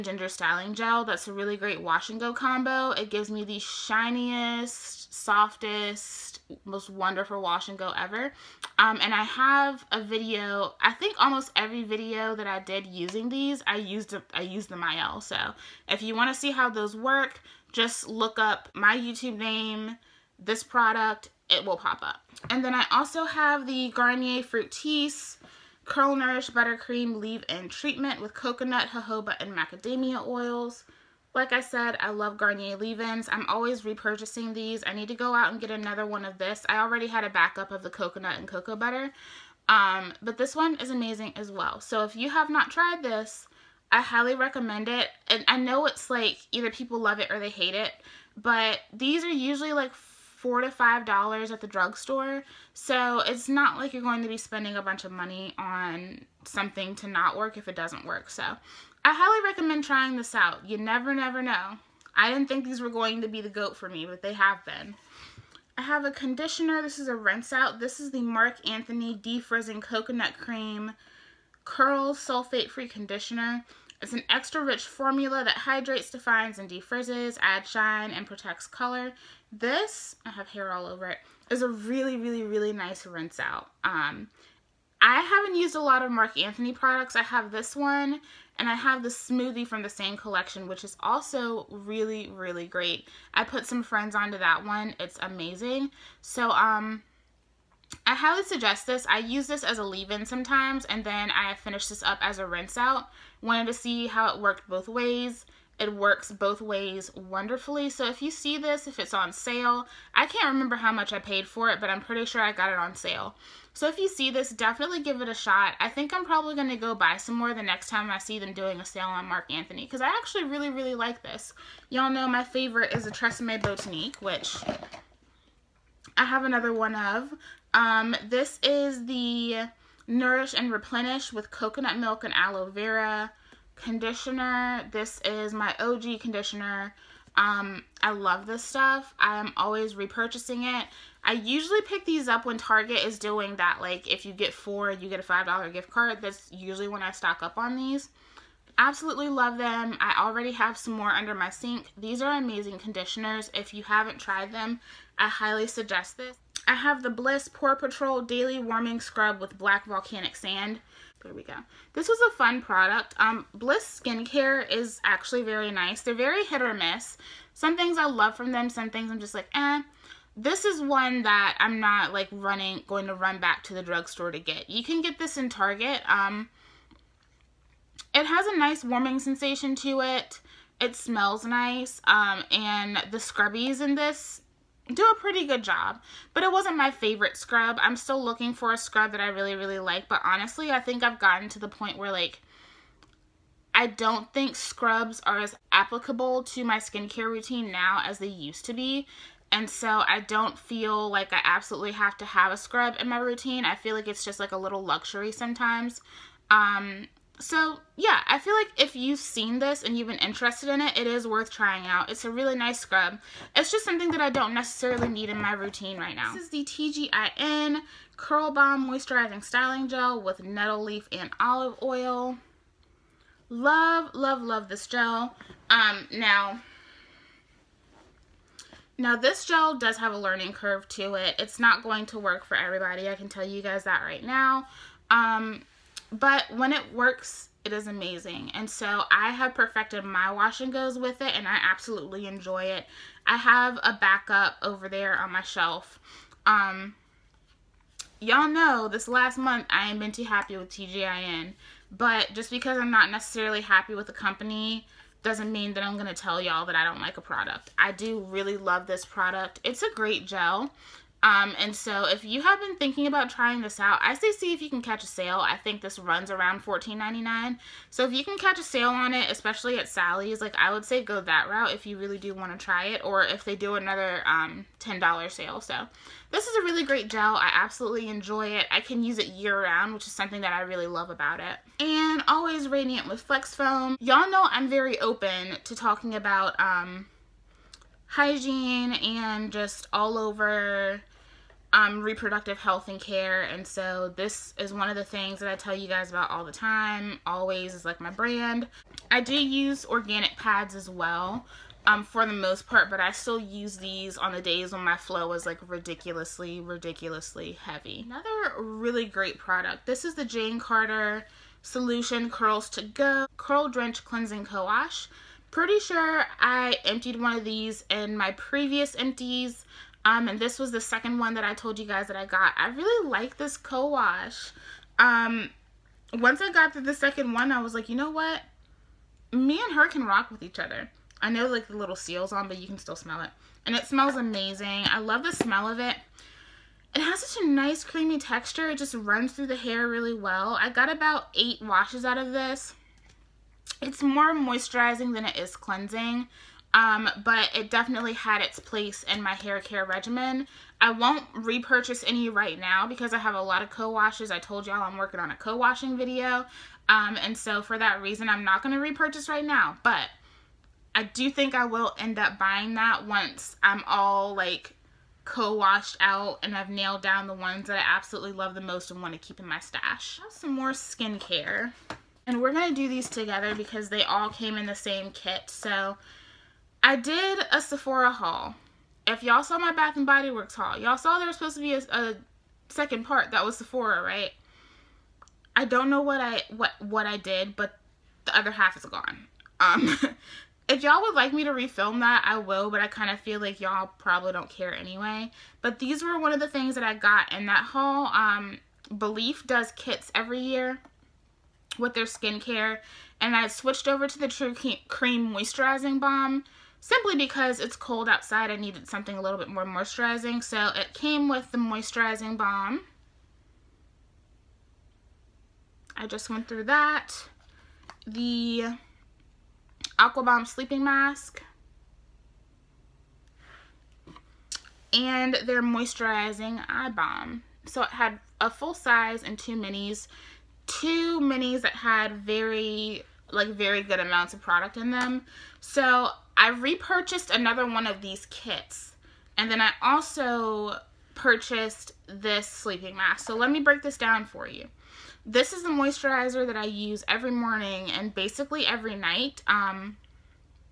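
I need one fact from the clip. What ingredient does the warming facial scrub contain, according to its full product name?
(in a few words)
Black Volcanic Sand.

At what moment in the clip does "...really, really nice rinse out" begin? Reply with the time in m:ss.
1:22.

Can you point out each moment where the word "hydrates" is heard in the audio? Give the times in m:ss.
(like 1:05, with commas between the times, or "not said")
1:15.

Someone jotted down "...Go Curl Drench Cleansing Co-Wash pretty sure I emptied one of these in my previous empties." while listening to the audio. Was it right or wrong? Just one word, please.
right.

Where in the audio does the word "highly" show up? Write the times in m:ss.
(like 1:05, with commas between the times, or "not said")
0:44, 0:59, 1:38, 2:35.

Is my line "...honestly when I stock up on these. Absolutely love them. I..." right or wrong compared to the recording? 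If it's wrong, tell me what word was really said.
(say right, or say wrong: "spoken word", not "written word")
wrong: "usually", not "honestly".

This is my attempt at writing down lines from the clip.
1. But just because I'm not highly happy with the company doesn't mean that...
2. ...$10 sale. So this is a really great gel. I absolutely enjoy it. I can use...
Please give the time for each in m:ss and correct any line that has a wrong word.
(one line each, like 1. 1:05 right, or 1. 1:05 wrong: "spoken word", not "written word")
1. 4:11 wrong: "necessarily", not "highly"
2. 4:34 right.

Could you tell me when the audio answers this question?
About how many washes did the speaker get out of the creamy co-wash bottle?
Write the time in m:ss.
5:41.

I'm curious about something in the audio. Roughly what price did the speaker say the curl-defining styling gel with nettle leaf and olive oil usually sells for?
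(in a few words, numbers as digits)
$14.99.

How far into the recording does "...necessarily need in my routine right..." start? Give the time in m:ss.
3:34.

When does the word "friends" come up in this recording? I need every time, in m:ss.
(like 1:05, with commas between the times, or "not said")
1:33.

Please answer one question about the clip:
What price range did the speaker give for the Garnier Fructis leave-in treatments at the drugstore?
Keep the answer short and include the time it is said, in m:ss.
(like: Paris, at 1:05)
$4 to $5, at 0:50.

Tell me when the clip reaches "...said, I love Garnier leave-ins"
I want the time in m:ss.
0:31.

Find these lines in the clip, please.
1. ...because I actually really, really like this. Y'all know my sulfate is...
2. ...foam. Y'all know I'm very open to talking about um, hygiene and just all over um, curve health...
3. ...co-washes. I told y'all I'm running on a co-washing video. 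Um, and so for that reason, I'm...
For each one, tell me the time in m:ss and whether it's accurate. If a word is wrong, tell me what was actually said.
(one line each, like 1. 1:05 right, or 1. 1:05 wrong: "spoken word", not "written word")
1. 1:59 wrong: "favorite", not "sulfate"
2. 4:43 wrong: "reproductive", not "curve"
3. 5:53 wrong: "working", not "running".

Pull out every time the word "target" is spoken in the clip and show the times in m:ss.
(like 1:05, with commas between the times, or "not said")
2:22, 2:55.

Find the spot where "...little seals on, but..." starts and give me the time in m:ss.
5:31.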